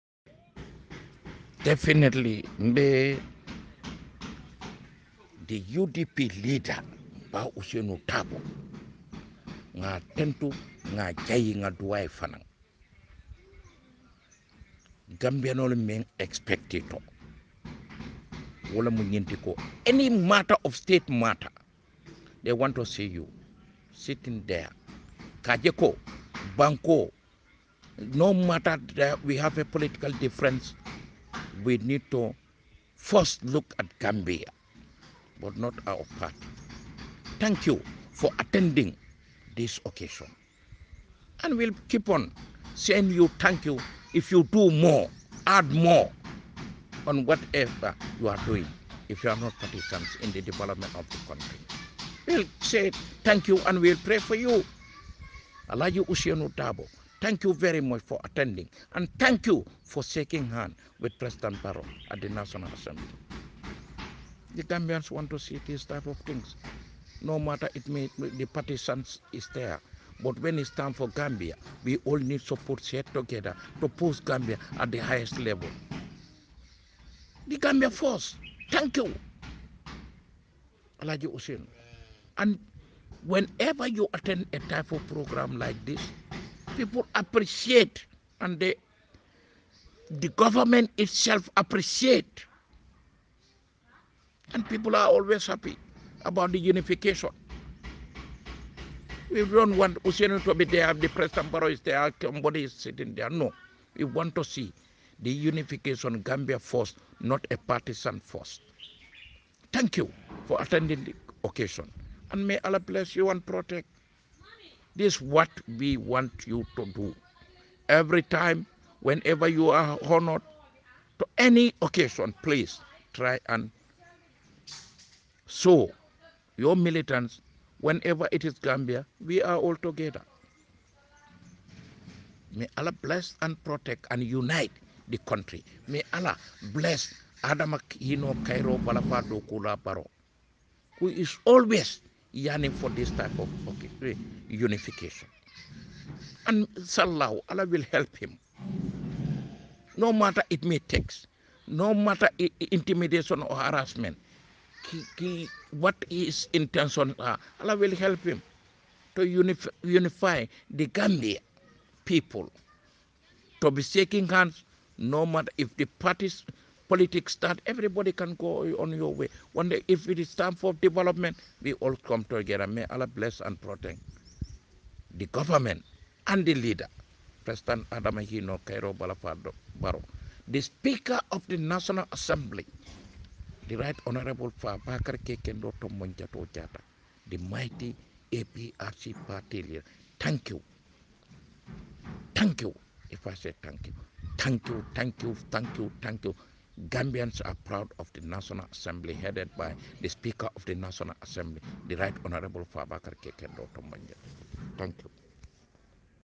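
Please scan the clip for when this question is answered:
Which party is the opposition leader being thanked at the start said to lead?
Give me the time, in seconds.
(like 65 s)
5 s.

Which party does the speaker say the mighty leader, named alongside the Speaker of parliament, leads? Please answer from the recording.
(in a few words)
APRC.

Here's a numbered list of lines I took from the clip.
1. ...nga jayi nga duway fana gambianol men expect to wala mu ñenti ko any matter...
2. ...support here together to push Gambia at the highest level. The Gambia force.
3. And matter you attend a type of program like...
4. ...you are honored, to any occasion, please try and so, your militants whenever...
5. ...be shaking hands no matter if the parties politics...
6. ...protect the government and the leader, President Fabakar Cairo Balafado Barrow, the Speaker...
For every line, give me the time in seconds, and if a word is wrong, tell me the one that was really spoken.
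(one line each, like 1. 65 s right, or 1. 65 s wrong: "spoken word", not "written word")
1. 10 s right
2. 72 s right
3. 82 s wrong: "whenever", not "matter"
4. 119 s right
5. 163 s right
6. 173 s wrong: "Adamahino", not "Fabakar".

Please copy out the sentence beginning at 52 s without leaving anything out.
We'll say thank you and we'll pray for you.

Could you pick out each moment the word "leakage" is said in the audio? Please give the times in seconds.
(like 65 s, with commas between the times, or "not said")
not said.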